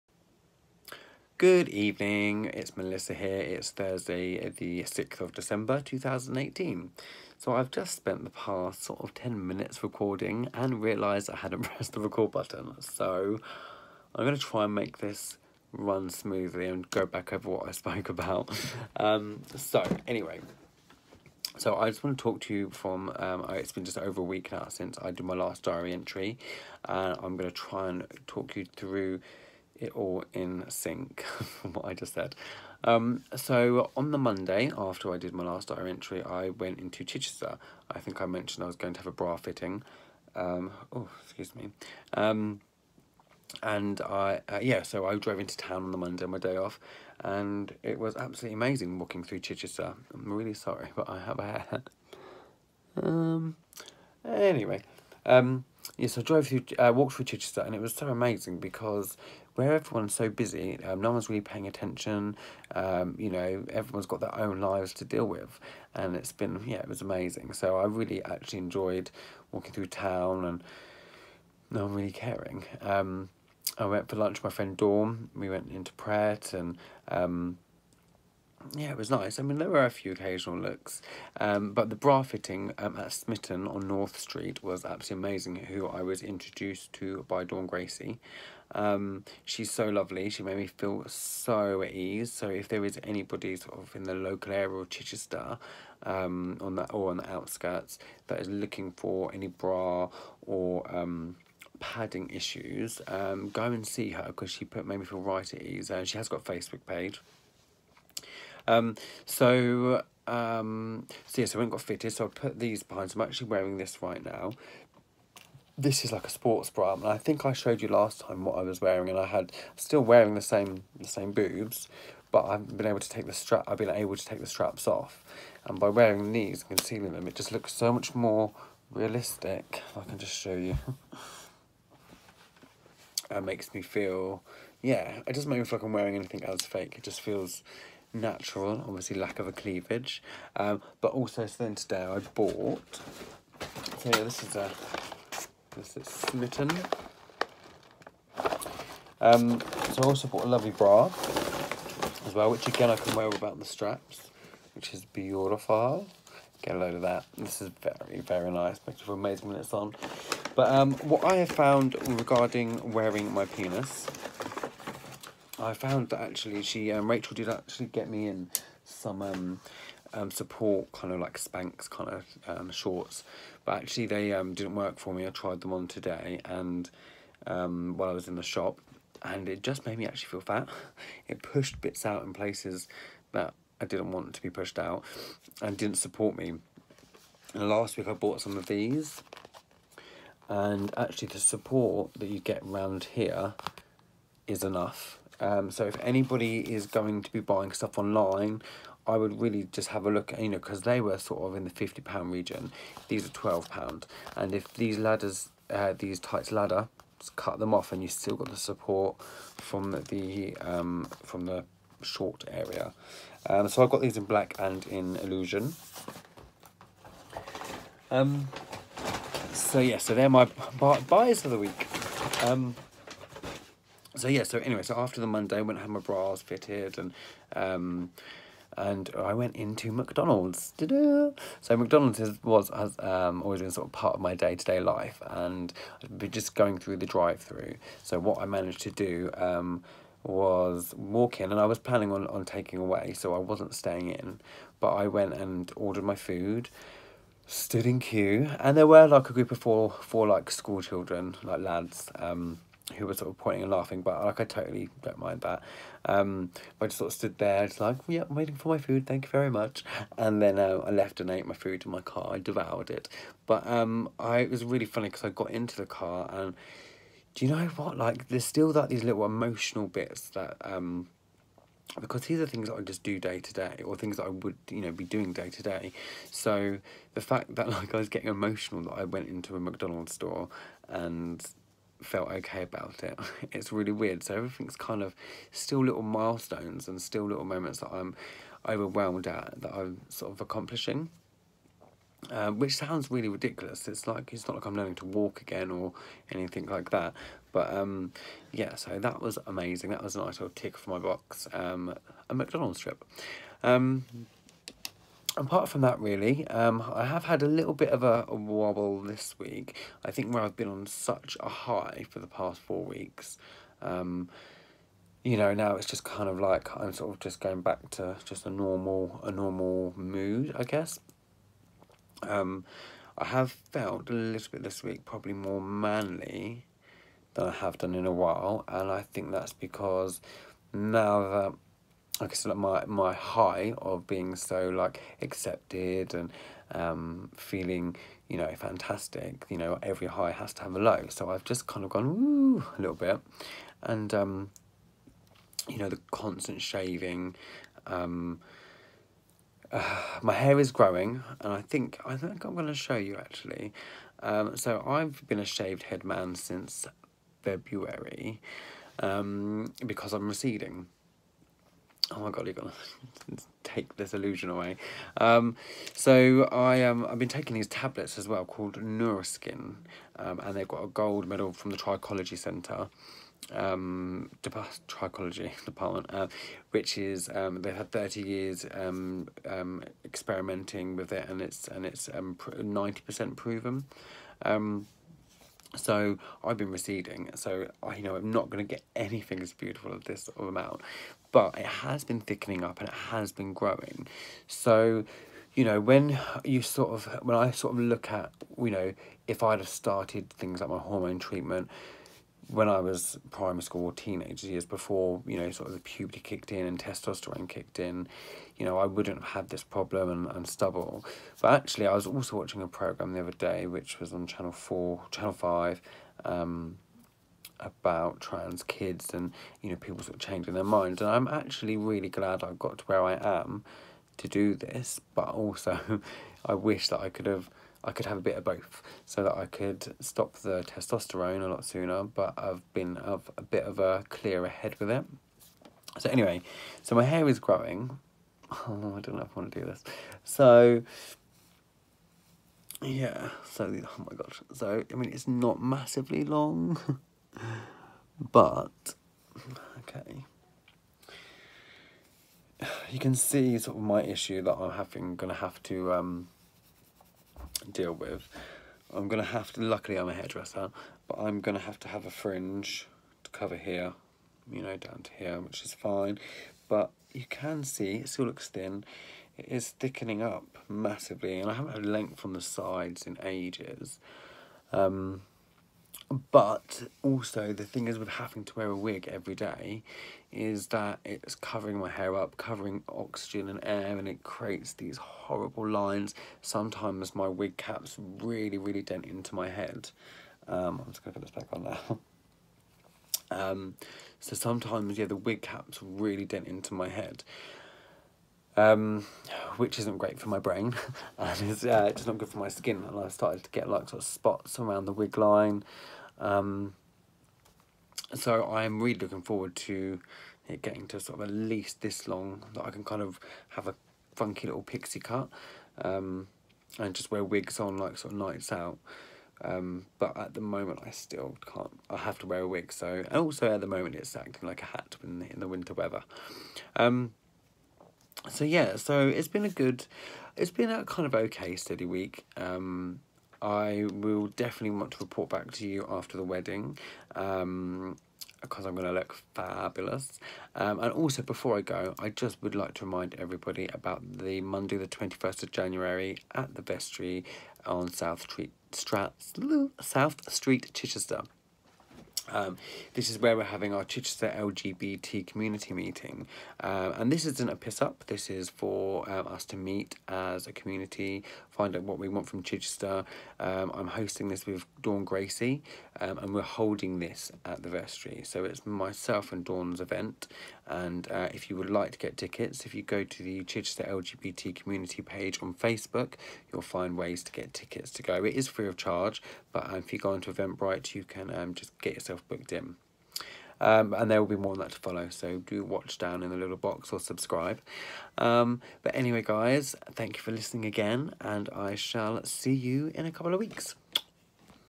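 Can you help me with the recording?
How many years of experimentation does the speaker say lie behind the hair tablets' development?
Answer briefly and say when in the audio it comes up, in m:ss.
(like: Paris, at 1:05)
30 years, at 6:17.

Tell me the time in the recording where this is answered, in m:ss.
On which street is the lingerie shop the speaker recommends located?
1:23.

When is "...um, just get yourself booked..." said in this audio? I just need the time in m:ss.
9:41.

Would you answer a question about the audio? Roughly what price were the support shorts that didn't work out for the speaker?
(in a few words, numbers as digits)
£50.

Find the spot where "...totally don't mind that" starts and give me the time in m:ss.
4:14.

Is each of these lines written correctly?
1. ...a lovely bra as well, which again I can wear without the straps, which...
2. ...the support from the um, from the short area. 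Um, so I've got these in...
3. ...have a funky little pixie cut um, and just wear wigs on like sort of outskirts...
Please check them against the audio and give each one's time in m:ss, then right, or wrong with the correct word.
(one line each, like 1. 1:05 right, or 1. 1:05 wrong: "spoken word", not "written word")
1. 2:30 right
2. 3:28 right
3. 8:33 wrong: "nights", not "outskirts".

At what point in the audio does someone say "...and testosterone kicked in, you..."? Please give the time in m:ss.
6:46.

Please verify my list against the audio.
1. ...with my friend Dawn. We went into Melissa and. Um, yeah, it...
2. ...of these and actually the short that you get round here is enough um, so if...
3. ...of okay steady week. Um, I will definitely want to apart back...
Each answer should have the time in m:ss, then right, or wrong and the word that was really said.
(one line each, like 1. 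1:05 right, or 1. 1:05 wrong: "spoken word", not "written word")
1. 1:14 wrong: "Pret", not "Melissa"
2. 3:08 wrong: "support", not "short"
3. 8:51 wrong: "report", not "apart".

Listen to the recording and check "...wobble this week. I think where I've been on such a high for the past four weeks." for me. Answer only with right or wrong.
right.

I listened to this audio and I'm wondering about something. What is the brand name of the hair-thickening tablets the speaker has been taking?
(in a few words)
Nourkrin.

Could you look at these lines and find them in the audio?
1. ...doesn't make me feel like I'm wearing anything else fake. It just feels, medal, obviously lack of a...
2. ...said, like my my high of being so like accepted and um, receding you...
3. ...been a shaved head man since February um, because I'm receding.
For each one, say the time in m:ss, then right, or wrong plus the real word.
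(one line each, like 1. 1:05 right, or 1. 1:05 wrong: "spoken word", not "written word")
1. 2:15 wrong: "natural", not "medal"
2. 5:32 wrong: "feeling", not "receding"
3. 5:55 right.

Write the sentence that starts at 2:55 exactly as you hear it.
I tried them on today and um, while I was in the shop, and it just made me actually feel fat.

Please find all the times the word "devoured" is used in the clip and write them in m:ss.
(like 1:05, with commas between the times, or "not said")
4:22.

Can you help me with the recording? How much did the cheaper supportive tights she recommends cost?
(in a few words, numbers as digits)
£12.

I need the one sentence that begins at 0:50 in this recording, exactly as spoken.
I'm really sorry, but I have a hair.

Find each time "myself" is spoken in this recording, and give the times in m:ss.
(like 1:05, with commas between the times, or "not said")
9:28.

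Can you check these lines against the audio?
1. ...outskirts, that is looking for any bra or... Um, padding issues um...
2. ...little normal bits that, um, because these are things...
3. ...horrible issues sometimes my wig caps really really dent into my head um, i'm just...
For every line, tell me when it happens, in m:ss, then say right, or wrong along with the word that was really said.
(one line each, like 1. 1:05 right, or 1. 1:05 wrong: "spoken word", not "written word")
1. 1:37 right
2. 4:29 wrong: "emotional", not "normal"
3. 8:04 wrong: "lines", not "issues".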